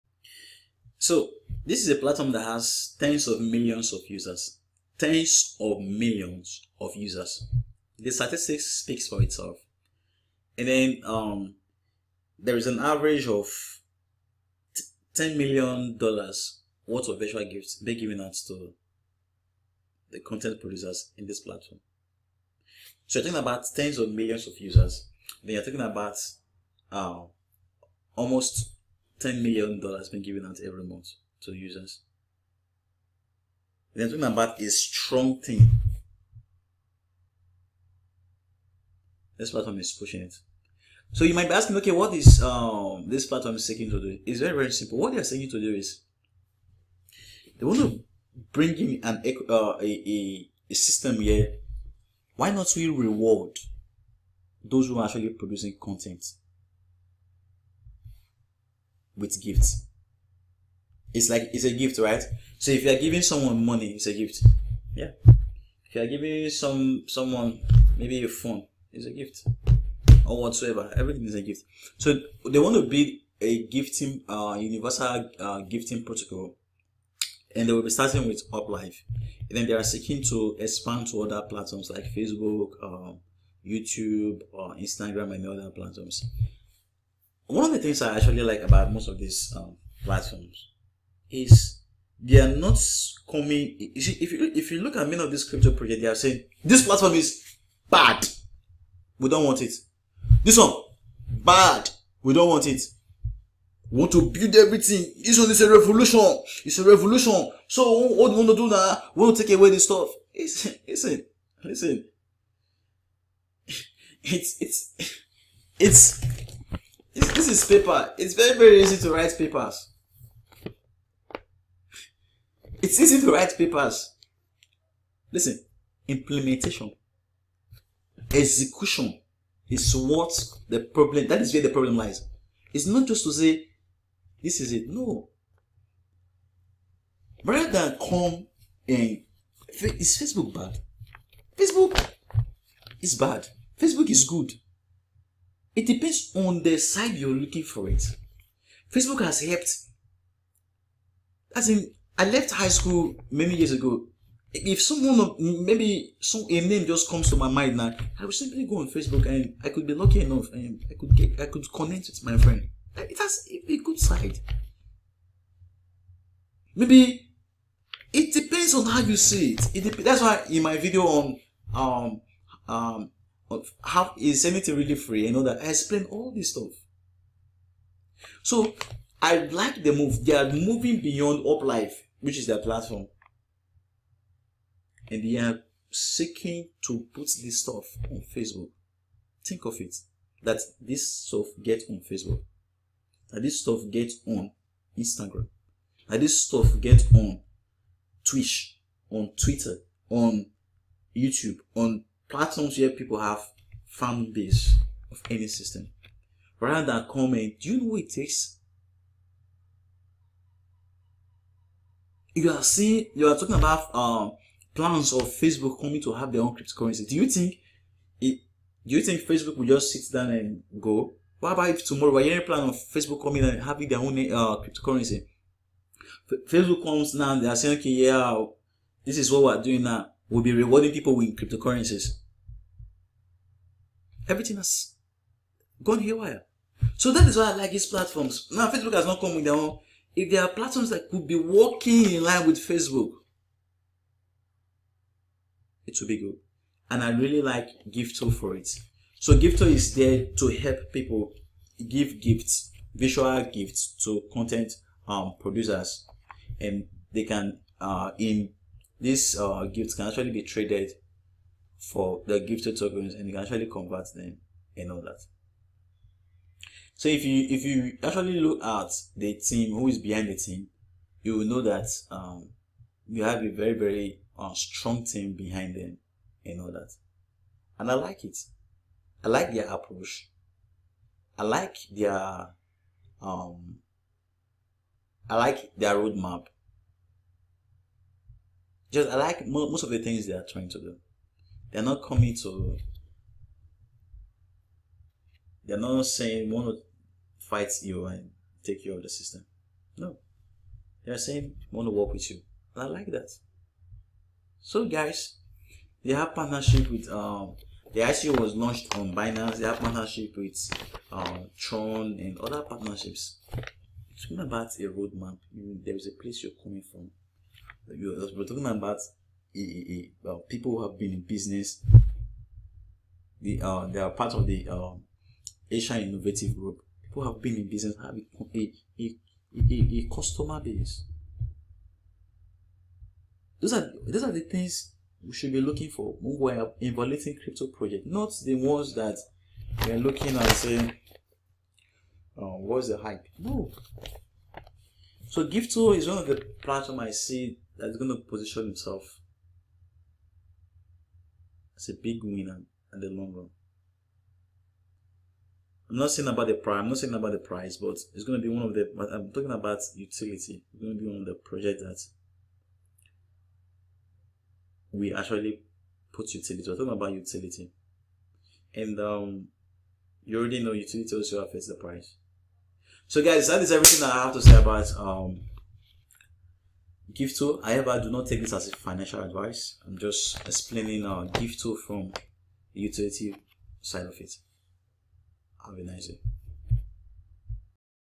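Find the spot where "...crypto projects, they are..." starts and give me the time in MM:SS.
01:35.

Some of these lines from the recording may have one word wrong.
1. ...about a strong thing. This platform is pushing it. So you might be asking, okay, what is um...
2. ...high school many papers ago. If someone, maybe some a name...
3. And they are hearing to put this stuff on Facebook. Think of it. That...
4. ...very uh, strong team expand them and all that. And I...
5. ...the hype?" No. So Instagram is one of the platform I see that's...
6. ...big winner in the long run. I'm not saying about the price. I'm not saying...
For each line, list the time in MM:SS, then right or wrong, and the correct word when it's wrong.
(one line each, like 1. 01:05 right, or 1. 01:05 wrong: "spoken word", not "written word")
1. 00:34 right
2. 02:32 wrong: "years", not "papers"
3. 03:05 wrong: "seeking", not "hearing"
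4. 04:33 wrong: "behind", not "expand"
5. 05:42 wrong: "Gifto", not "Instagram"
6. 05:52 right.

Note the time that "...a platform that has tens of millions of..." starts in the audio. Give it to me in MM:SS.
00:01.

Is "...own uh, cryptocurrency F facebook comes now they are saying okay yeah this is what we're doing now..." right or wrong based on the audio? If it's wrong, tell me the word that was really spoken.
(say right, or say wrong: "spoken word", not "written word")
right.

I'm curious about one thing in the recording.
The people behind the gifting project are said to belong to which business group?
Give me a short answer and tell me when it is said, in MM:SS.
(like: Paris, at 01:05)
Asian Innovative Group, at 05:25.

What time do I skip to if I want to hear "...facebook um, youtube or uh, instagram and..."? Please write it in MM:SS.
01:22.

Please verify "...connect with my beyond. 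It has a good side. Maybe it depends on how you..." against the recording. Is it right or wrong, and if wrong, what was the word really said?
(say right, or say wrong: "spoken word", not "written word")
wrong: "friend", not "beyond".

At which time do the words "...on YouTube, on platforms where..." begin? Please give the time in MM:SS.
03:20.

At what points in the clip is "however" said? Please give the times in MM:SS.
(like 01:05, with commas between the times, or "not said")
06:17.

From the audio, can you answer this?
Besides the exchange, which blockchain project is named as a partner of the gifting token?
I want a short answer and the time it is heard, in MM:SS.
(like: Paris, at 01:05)
Tron, at 05:09.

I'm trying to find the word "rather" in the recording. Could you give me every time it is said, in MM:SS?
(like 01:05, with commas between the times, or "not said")
02:17, 03:26.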